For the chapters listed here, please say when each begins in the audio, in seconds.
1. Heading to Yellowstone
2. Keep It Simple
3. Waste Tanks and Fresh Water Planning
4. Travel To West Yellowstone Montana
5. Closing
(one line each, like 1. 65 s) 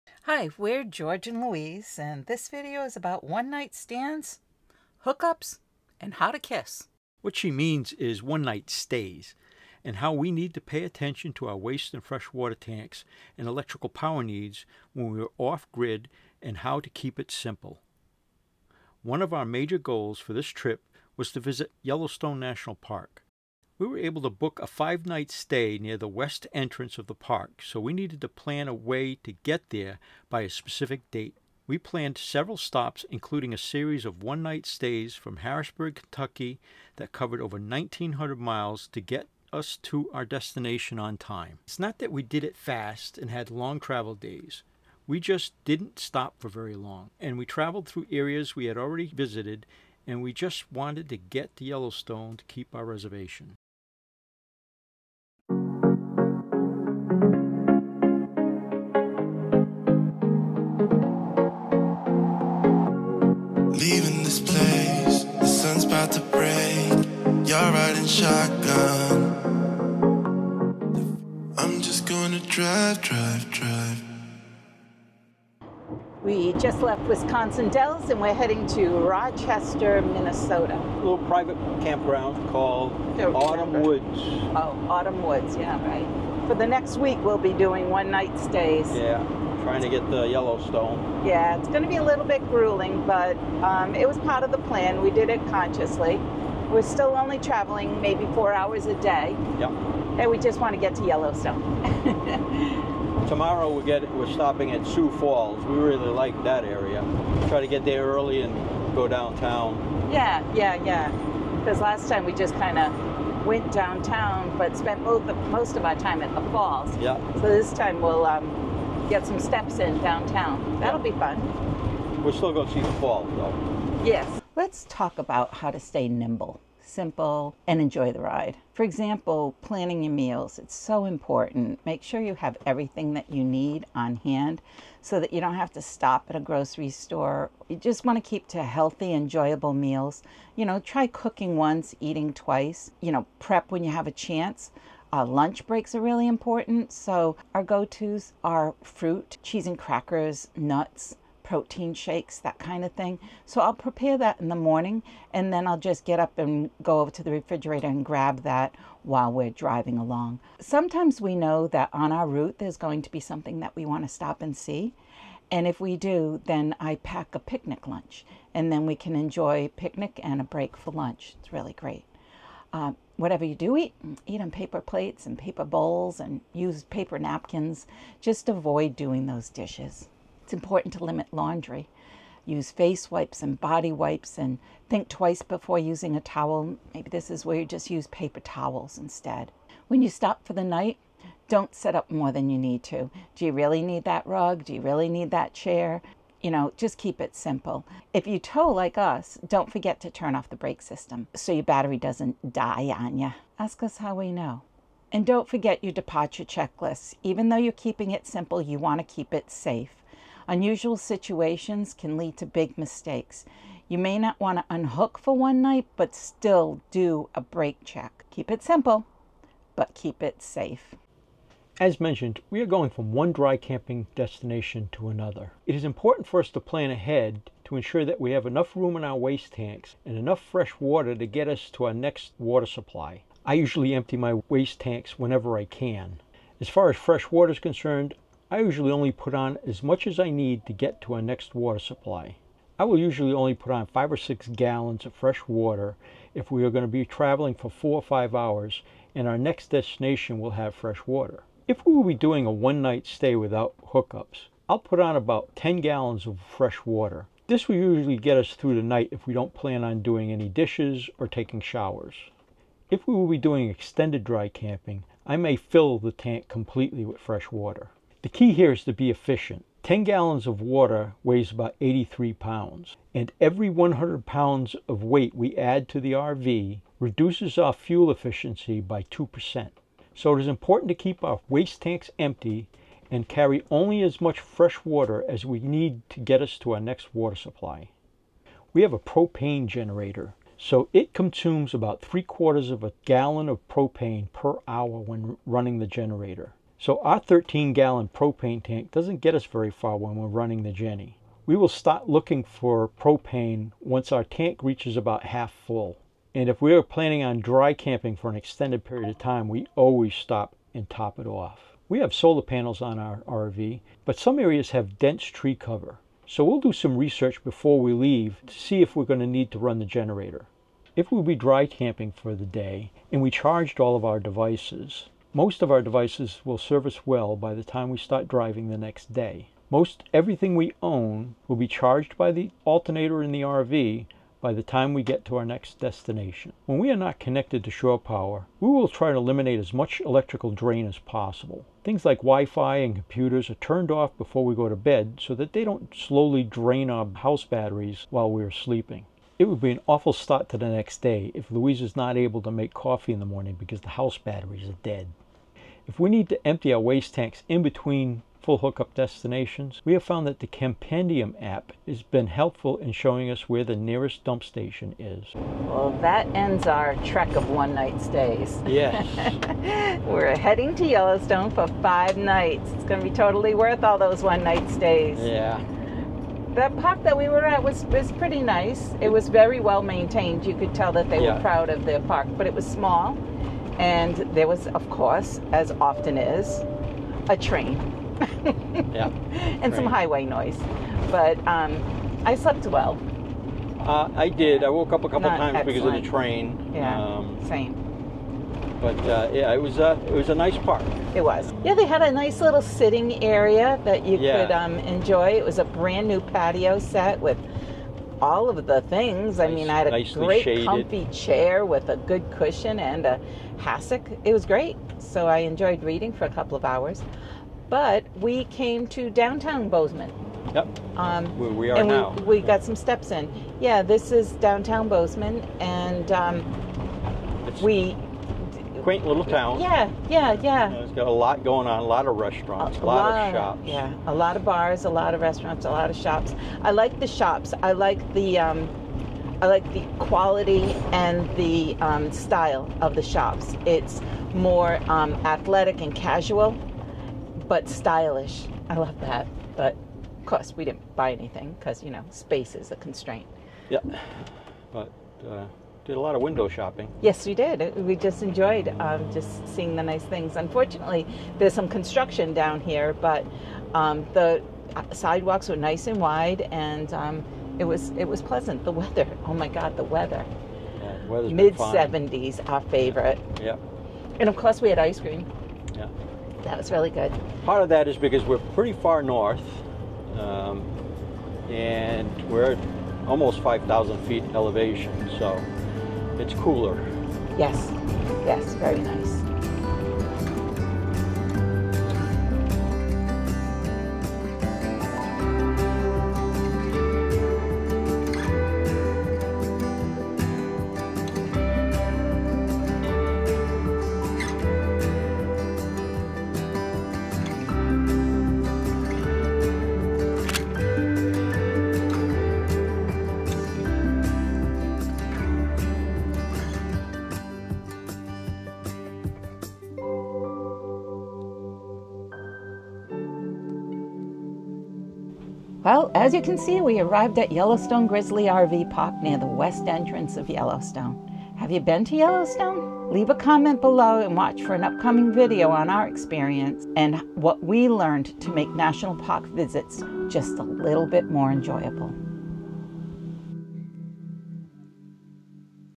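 1. 76 s
2. 126 s
3. 222 s
4. 370 s
5. 526 s.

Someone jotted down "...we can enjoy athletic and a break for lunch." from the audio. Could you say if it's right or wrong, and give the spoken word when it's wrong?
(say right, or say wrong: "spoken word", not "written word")
wrong: "picnic", not "athletic".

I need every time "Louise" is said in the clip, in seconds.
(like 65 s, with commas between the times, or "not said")
1 s, 351 s.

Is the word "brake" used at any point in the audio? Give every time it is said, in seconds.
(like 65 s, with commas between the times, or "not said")
200 s, 217 s.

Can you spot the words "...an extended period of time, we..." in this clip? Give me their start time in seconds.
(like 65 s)
308 s.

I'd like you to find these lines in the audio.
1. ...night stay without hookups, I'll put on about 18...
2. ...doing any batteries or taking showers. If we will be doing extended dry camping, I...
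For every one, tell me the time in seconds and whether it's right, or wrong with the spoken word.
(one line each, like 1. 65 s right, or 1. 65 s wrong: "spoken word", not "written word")
1. 252 s wrong: "10", not "18"
2. 260 s wrong: "dishes", not "batteries".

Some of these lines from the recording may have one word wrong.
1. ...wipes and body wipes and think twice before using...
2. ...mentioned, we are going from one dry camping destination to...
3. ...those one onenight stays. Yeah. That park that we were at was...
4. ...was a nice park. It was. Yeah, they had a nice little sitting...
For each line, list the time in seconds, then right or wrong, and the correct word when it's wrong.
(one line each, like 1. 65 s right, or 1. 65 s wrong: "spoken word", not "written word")
1. 183 s right
2. 221 s right
3. 373 s wrong: "night", not "onenight"
4. 400 s right.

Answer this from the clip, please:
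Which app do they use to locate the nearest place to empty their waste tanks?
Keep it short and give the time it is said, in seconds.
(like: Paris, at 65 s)
Campendium, at 360 s.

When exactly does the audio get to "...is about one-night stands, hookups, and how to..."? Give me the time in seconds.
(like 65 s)
2 s.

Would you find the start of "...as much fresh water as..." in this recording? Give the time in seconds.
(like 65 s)
284 s.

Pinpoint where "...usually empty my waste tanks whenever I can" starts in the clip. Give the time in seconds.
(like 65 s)
233 s.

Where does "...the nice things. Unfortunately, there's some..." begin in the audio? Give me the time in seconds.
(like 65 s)
459 s.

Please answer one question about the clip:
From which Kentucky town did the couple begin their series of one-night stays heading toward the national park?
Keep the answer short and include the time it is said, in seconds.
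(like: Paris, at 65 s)
Harrodsburg, at 35 s.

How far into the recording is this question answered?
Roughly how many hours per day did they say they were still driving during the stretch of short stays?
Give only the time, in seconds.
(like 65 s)
98 s.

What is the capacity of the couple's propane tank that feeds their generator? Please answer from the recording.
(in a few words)
13 gallons.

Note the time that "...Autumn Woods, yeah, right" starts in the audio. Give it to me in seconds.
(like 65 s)
84 s.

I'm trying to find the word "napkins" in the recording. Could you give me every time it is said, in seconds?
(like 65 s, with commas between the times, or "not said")
177 s.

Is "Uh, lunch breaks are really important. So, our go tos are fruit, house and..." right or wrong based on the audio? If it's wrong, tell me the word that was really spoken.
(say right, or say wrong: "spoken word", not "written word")
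wrong: "cheese", not "house".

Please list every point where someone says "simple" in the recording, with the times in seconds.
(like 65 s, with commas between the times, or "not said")
17 s, 126 s, 197 s, 208 s, 218 s.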